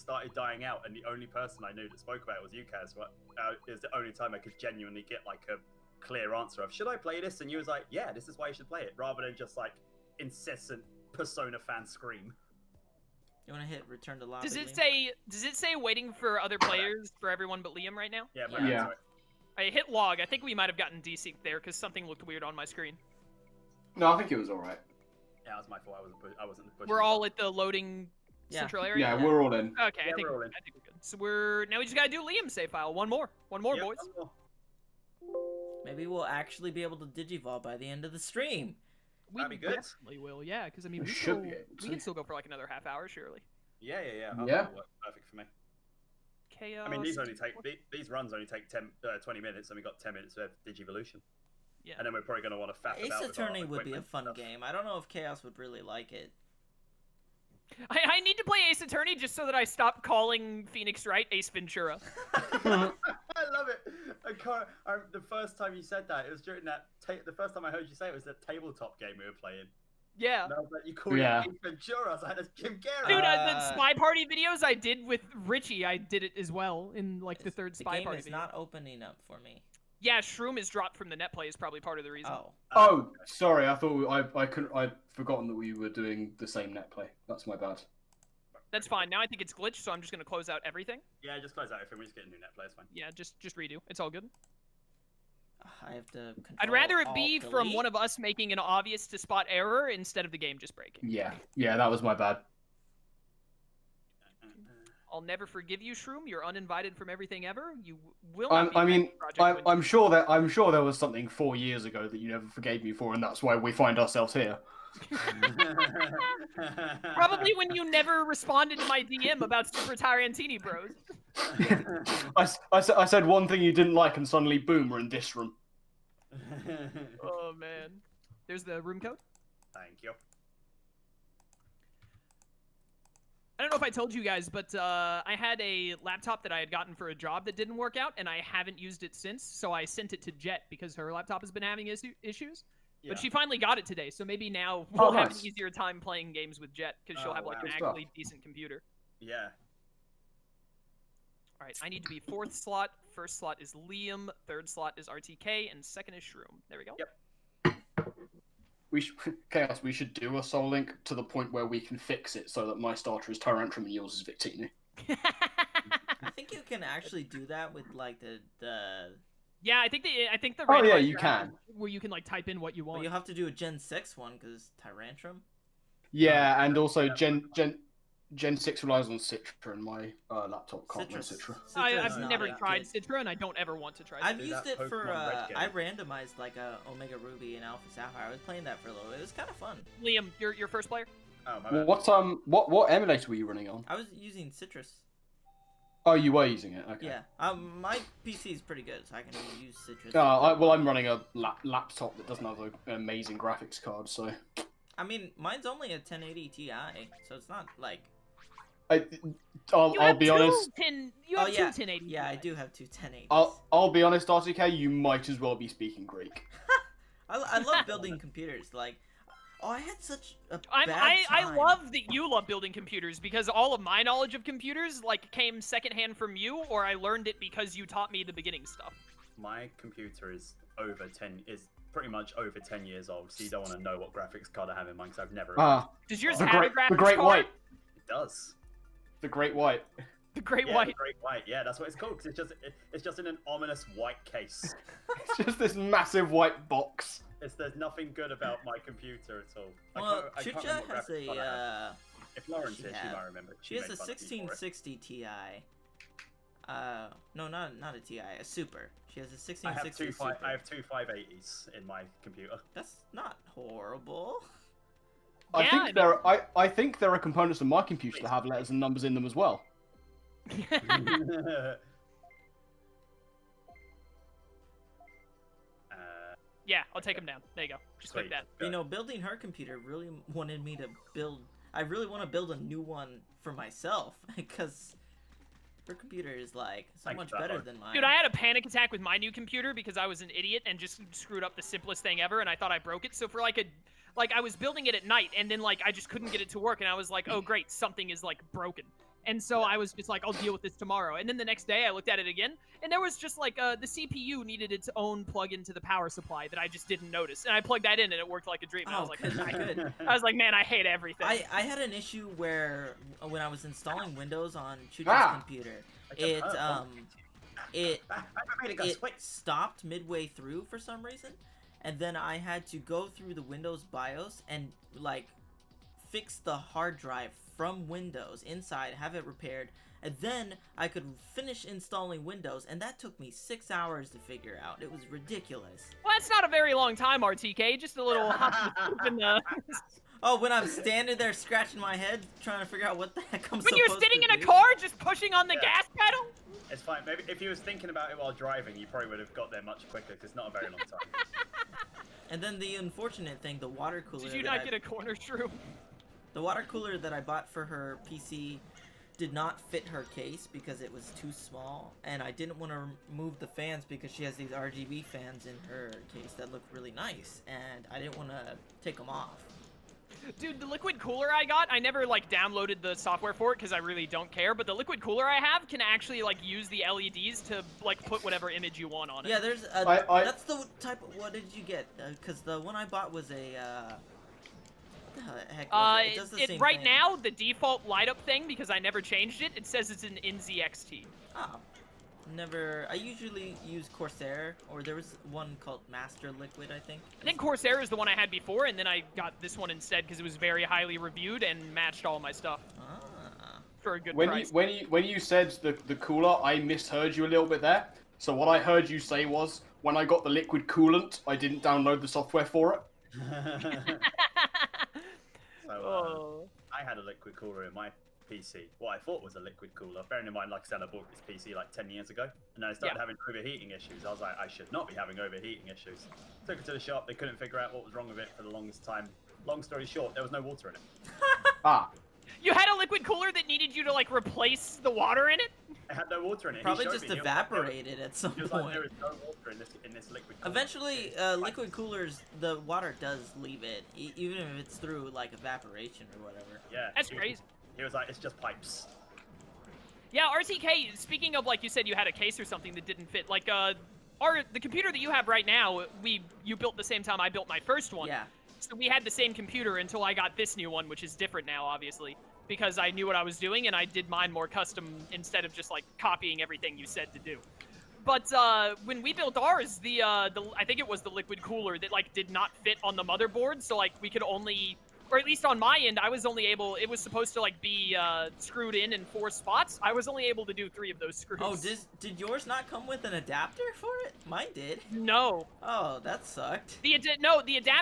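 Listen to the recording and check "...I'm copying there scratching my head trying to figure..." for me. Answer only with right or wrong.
wrong.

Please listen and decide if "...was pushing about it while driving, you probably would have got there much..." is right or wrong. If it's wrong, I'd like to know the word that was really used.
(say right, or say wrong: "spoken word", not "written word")
wrong: "thinking", not "pushing".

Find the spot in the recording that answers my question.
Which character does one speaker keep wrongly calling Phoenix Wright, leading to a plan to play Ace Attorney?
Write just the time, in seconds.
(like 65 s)
61 s.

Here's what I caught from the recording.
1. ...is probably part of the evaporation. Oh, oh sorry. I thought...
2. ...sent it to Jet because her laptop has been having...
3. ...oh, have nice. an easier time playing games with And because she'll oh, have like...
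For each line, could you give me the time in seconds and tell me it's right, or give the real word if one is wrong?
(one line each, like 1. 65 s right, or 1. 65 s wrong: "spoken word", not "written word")
1. 81 s wrong: "reason", not "evaporation"
2. 139 s right
3. 145 s wrong: "Jet", not "And".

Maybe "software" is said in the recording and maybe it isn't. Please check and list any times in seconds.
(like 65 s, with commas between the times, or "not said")
372 s, 412 s.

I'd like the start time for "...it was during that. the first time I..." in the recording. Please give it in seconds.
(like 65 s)
66 s.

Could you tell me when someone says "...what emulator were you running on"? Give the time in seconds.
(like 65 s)
192 s.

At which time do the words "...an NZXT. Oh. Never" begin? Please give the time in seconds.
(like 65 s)
390 s.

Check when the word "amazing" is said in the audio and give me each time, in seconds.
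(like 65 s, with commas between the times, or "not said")
202 s.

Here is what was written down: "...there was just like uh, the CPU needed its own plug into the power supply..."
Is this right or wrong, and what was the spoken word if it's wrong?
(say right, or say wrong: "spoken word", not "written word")
right.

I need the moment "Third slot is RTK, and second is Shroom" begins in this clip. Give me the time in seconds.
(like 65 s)
154 s.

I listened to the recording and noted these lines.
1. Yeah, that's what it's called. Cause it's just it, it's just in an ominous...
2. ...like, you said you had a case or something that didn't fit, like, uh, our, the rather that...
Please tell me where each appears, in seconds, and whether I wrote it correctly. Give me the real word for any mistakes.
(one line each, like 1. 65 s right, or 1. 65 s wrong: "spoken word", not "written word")
1. 241 s right
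2. 451 s wrong: "computer", not "rather".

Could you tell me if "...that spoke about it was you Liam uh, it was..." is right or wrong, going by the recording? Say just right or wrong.
wrong.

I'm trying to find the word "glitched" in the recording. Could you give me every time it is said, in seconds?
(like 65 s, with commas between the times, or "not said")
89 s.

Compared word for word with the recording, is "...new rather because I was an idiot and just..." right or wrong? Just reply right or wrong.
wrong.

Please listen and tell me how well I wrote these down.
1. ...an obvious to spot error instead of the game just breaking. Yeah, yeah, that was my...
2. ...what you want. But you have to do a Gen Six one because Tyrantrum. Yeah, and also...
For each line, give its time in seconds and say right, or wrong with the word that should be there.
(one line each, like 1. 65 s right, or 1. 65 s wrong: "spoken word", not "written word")
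1. 98 s right
2. 172 s right.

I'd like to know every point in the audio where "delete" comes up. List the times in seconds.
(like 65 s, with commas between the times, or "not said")
97 s.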